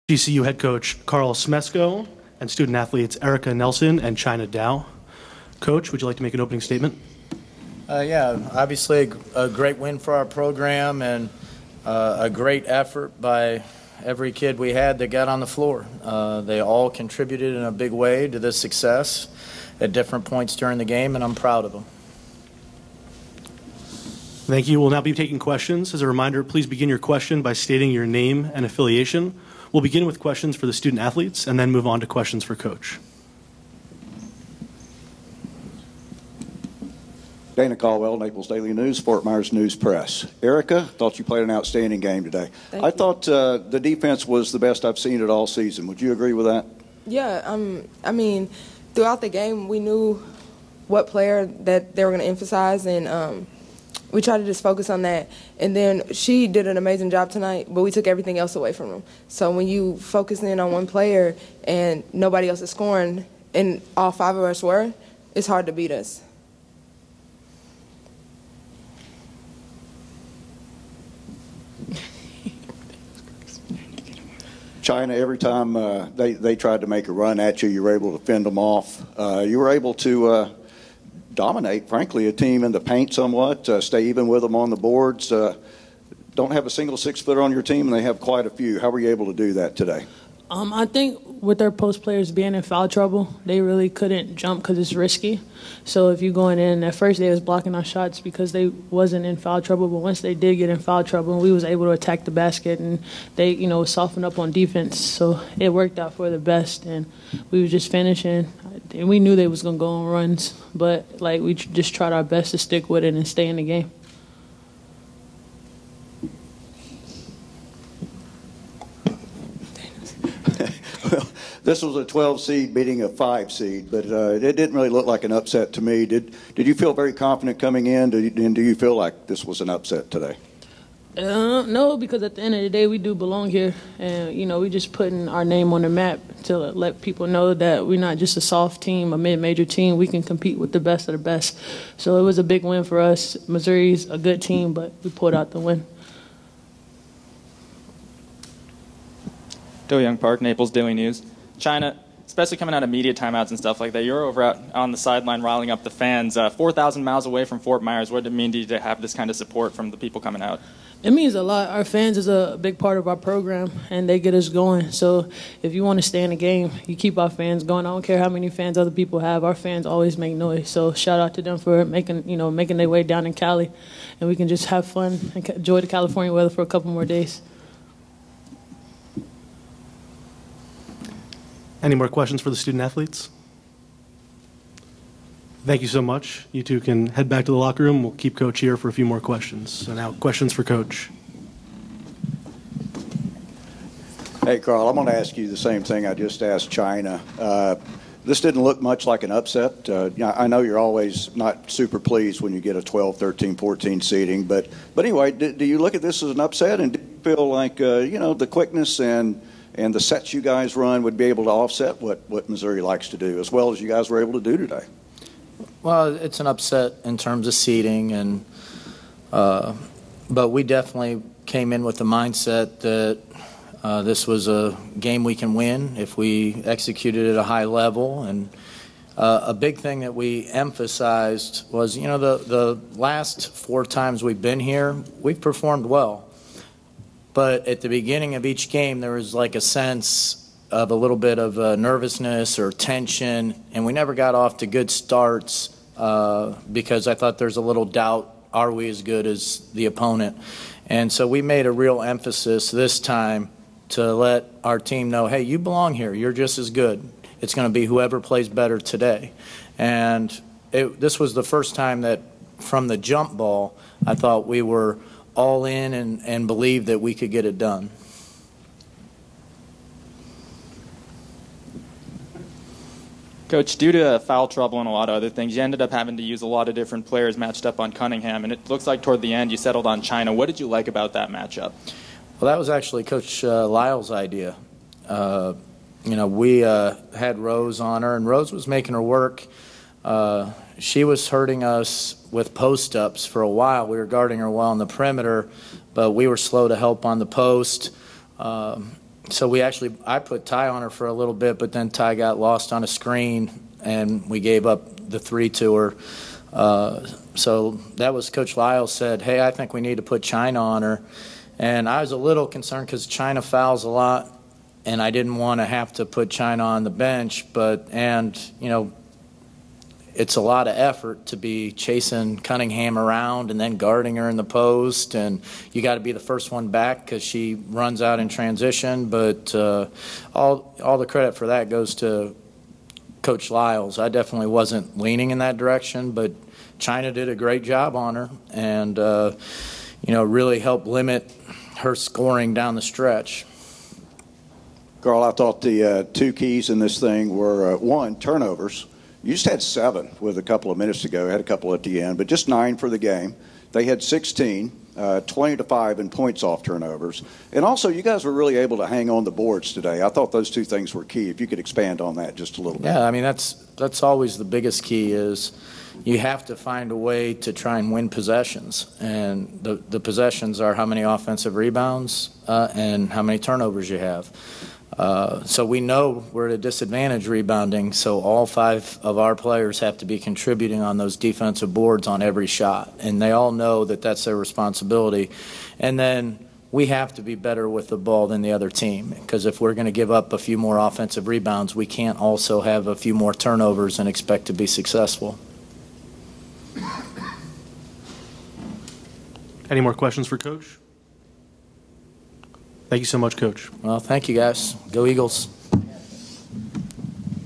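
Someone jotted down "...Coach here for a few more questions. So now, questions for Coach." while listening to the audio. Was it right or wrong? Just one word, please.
right.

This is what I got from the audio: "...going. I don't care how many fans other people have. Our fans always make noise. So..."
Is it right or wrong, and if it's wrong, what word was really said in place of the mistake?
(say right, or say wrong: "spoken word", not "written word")
right.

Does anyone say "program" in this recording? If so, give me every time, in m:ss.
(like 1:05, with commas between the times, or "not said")
0:10, 2:43.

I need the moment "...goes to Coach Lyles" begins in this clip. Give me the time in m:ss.
5:31.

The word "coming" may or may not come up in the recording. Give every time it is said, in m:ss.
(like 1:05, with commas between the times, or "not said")
2:07, 2:32, 2:40.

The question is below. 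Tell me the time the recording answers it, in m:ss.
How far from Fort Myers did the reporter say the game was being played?
2:36.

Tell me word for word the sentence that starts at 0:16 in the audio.
Uh, they all contributed in a big way to this success at different points during the game, and I'm proud of them.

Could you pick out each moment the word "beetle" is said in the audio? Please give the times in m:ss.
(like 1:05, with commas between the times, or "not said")
not said.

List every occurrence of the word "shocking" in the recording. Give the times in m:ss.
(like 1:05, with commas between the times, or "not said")
not said.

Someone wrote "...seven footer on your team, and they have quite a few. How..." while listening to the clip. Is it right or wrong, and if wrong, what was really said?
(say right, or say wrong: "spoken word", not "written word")
wrong: "six", not "seven".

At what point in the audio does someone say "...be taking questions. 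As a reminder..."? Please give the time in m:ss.
0:25.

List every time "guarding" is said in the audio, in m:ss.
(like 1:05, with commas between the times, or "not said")
4:54, 5:23.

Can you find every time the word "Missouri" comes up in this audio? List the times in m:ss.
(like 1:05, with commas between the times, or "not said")
2:23, 3:32.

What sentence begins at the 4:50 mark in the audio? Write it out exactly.
Uh, she was hurting us with post ups for a while.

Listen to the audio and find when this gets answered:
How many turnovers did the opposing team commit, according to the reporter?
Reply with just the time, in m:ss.
5:54.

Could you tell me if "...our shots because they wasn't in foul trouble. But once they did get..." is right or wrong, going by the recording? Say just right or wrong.
right.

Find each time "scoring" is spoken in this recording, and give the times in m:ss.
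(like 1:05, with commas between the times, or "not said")
1:02, 5:41.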